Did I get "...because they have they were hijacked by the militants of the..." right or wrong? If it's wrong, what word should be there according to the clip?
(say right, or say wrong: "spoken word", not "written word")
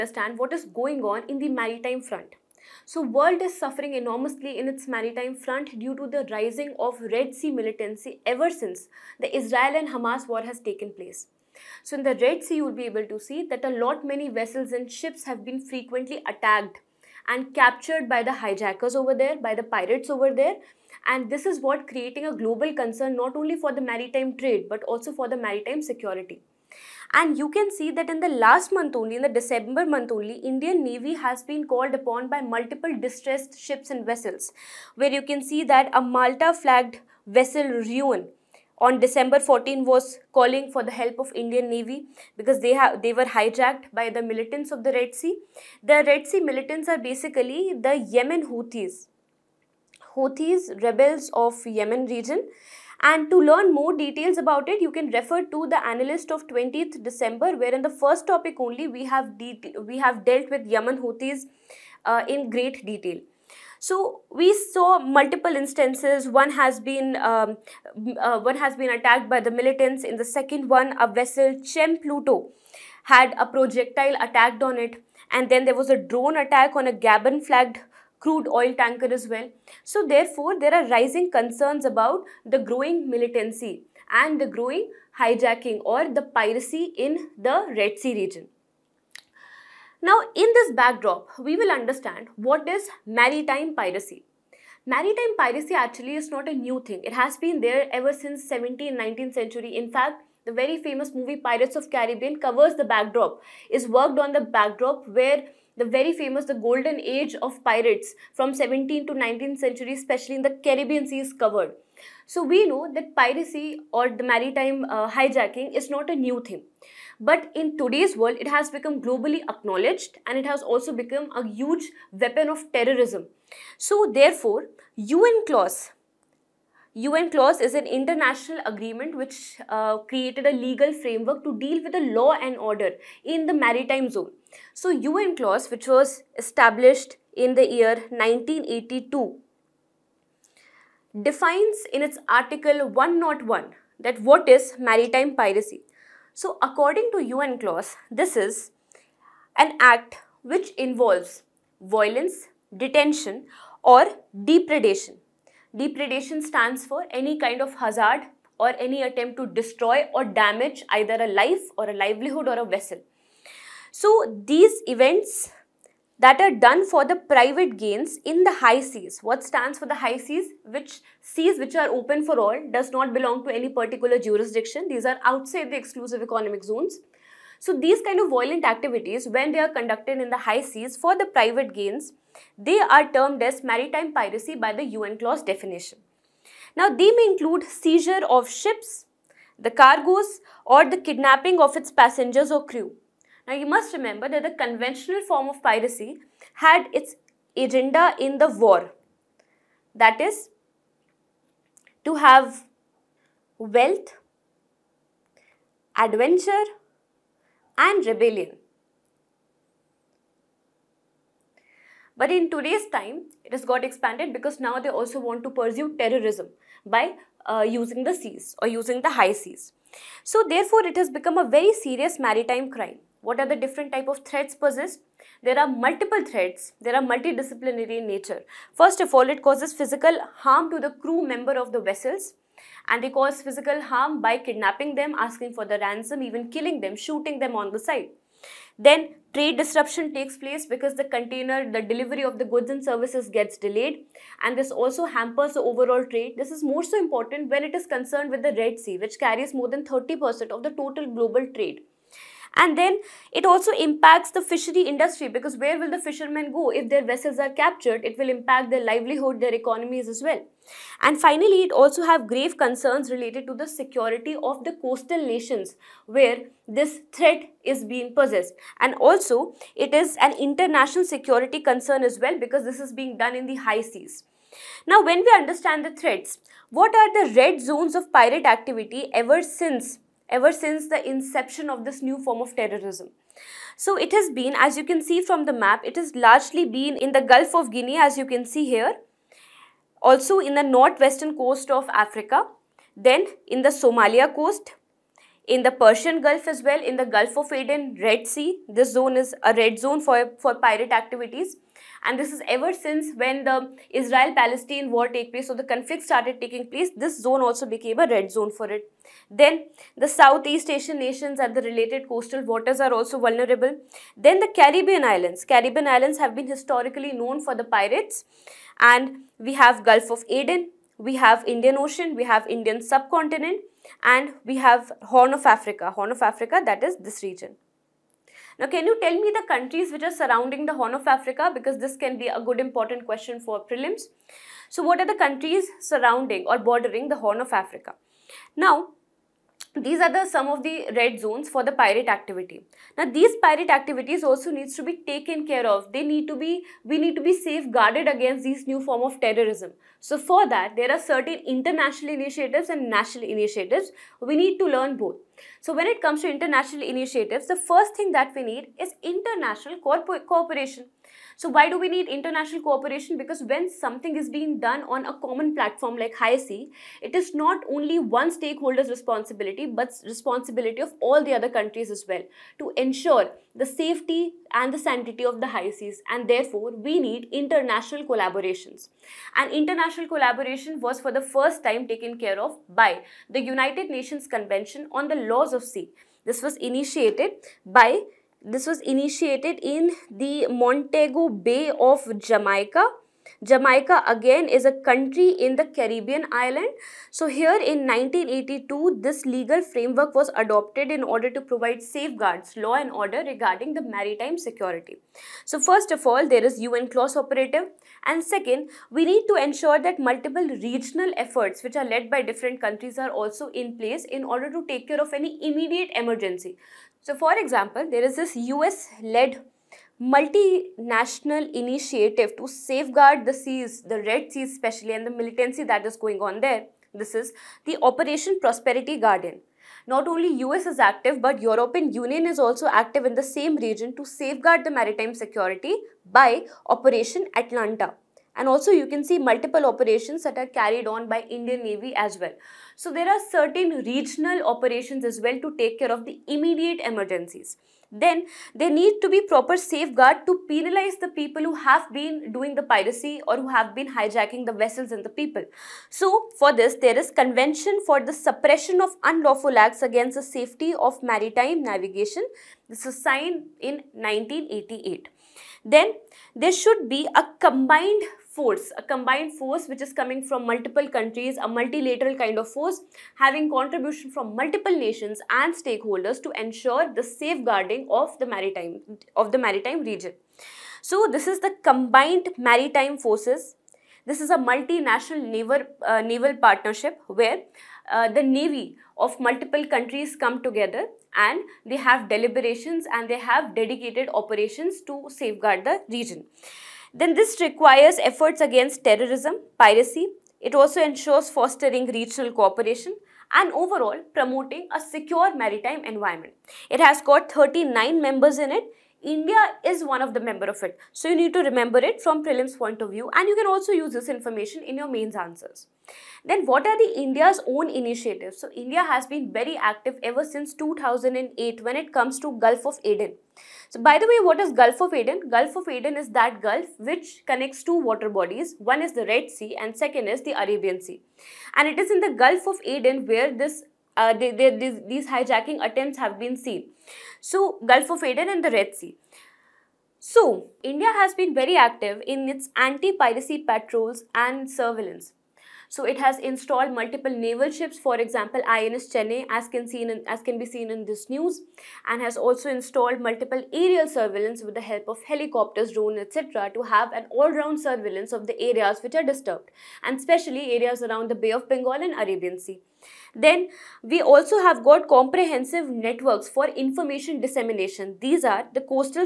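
right.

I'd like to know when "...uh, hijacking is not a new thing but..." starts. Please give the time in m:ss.
1:54.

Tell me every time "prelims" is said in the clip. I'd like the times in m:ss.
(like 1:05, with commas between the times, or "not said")
5:33, 8:32.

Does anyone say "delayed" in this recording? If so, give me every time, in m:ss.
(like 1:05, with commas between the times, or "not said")
4:03.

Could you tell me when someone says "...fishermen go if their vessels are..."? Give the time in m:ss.
4:15.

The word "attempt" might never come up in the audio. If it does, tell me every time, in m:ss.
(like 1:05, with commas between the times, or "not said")
2:39, 8:55.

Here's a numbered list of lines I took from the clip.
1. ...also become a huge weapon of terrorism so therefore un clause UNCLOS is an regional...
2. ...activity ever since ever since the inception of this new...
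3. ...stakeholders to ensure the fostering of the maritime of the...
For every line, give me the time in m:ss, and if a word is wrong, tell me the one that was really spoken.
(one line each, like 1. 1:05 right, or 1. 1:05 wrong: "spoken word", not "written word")
1. 2:00 wrong: "international", not "regional"
2. 4:38 right
3. 7:55 wrong: "safeguarding", not "fostering".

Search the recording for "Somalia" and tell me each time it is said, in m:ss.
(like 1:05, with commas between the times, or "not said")
4:53.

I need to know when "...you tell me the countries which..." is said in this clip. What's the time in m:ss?
5:28.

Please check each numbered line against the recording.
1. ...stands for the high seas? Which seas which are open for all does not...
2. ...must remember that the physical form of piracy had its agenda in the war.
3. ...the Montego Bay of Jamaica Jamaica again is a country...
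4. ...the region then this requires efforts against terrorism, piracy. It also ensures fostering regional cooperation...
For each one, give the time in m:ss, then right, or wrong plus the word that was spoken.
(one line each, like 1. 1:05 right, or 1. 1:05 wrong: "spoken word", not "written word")
1. 2:49 right
2. 3:13 wrong: "conventional", not "physical"
3. 6:30 right
4. 8:15 right.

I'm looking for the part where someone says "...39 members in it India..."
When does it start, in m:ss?
8:27.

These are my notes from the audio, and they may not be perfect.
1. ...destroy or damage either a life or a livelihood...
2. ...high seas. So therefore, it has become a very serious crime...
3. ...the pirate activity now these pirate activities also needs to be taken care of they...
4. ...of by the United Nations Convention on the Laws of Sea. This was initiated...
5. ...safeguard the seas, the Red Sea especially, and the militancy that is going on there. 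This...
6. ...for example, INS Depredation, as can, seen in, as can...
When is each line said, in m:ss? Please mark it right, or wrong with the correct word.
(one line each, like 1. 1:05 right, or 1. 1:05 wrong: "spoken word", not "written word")
1. 2:39 right
2. 3:39 wrong: "maritime", not "crime"
3. 5:41 right
4. 6:22 right
5. 7:02 right
6. 9:07 wrong: "Chennai", not "Depredation".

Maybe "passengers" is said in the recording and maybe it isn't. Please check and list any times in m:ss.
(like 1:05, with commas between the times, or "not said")
3:11.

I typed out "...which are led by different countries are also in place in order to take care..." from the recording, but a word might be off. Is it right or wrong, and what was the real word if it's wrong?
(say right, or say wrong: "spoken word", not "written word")
right.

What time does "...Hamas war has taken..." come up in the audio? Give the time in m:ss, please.
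0:09.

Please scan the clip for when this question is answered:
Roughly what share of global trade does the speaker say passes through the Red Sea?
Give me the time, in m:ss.
4:09.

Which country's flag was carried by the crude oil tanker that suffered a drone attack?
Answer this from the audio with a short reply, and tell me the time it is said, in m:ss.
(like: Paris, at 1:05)
Gabon, at 1:16.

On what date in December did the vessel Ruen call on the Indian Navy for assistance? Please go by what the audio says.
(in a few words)
December 14.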